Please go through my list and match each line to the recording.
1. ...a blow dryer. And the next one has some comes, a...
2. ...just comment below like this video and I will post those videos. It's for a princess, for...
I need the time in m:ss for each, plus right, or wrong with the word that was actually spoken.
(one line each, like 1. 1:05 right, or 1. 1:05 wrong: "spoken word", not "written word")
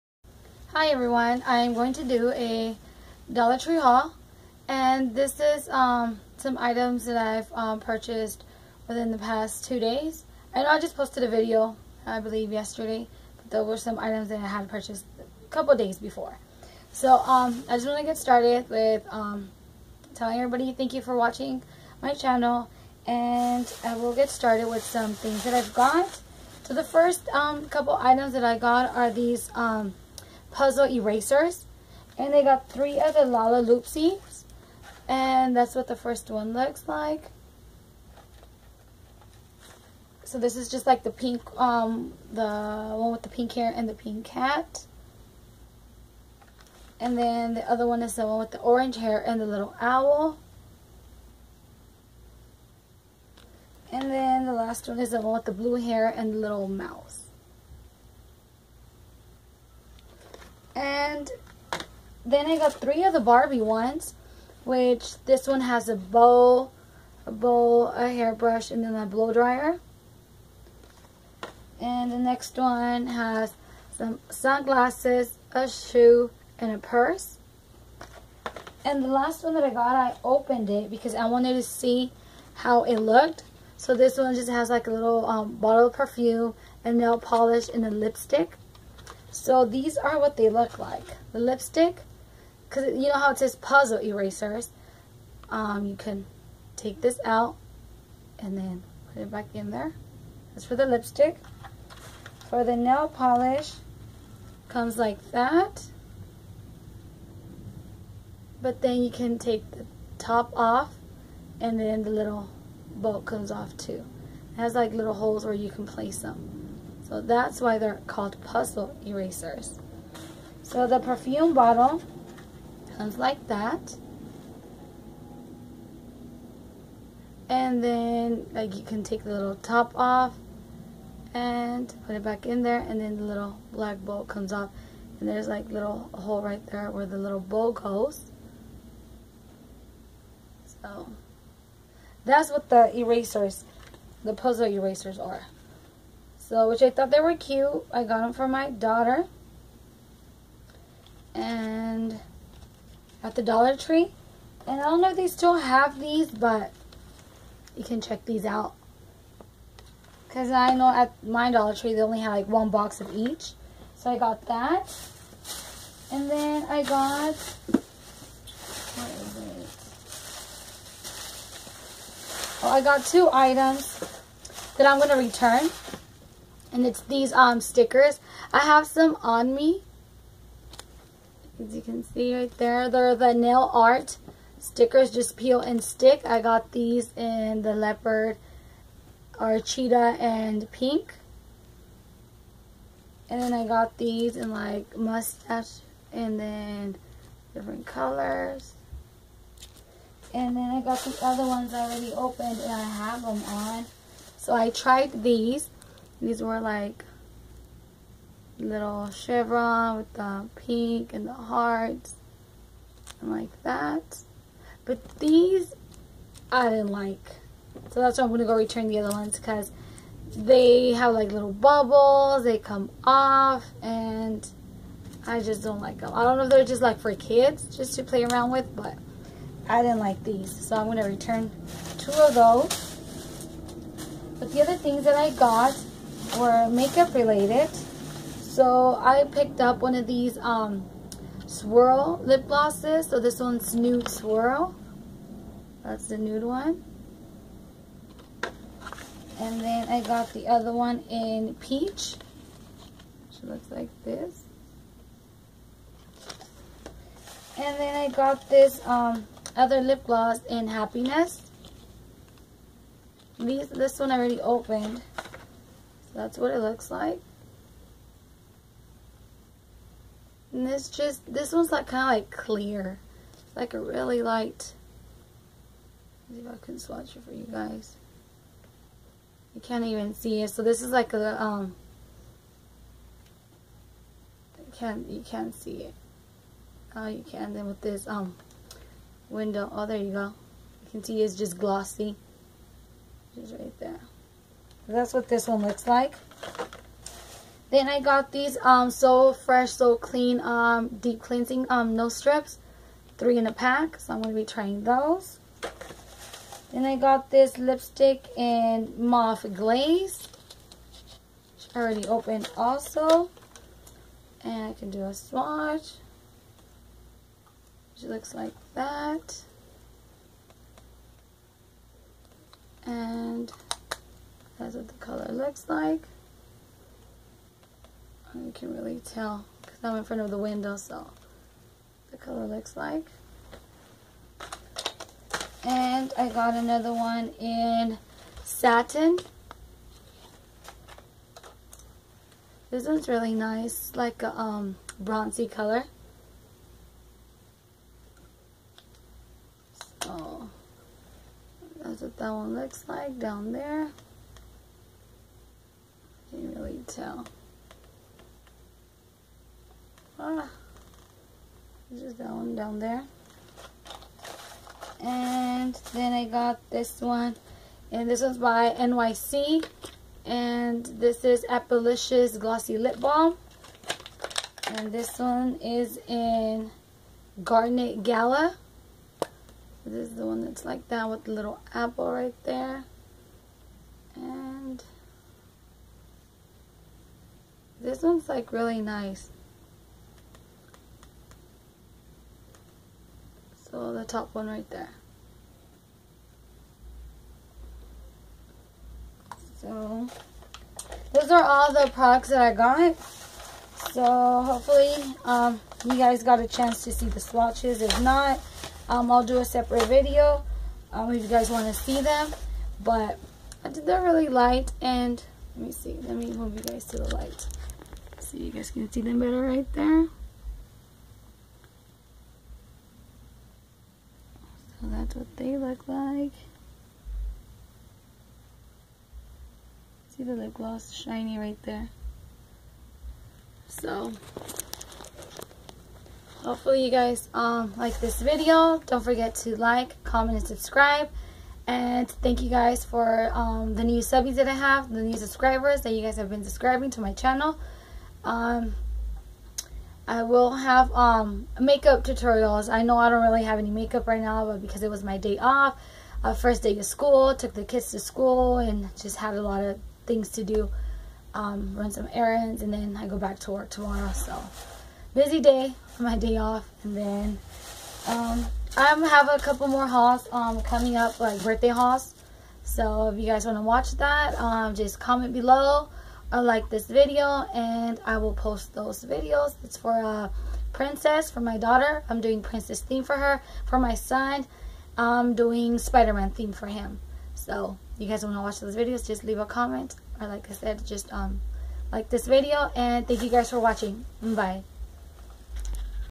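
1. 1:08 wrong: "sunglasses", not "comes"
2. 7:54 right.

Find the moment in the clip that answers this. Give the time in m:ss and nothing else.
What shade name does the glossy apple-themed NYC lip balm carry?
6:17.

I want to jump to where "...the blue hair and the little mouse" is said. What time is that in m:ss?
0:55.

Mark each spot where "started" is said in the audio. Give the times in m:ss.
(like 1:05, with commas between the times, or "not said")
0:18, 0:24.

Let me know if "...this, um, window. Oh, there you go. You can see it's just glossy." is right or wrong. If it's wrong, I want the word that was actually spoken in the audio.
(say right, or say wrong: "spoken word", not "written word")
right.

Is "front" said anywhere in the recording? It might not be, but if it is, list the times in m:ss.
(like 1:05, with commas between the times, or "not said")
5:30.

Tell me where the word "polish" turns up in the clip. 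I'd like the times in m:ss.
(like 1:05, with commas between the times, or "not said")
1:27, 1:43.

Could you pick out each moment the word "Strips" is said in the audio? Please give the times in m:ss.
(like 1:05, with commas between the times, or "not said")
5:02.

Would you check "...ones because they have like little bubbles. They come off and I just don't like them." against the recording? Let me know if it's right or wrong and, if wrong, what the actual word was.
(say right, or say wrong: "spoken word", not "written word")
right.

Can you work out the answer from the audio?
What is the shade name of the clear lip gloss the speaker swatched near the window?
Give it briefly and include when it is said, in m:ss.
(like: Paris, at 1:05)
Happiness, at 4:20.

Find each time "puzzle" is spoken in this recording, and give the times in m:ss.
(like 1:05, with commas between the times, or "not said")
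0:30, 1:33, 1:58, 2:24.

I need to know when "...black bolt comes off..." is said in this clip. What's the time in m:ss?
2:13.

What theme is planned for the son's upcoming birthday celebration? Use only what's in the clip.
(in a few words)
Spider-Man.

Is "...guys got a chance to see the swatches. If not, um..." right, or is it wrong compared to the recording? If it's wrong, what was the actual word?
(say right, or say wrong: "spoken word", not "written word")
right.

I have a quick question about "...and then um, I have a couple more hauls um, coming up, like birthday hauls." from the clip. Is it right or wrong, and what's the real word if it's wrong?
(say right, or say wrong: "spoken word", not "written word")
right.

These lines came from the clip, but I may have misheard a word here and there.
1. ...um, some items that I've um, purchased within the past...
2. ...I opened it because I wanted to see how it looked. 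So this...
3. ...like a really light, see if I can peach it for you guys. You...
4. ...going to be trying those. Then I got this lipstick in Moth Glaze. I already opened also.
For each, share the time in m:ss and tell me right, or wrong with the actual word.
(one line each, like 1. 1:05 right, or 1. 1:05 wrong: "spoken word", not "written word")
1. 0:05 right
2. 1:19 right
3. 4:33 wrong: "swatch", not "peach"
4. 5:04 right.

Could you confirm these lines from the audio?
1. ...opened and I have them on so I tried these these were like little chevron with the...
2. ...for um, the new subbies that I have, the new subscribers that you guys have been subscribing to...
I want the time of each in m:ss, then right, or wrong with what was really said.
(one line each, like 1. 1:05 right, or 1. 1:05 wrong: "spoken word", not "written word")
1. 3:22 right
2. 7:22 right.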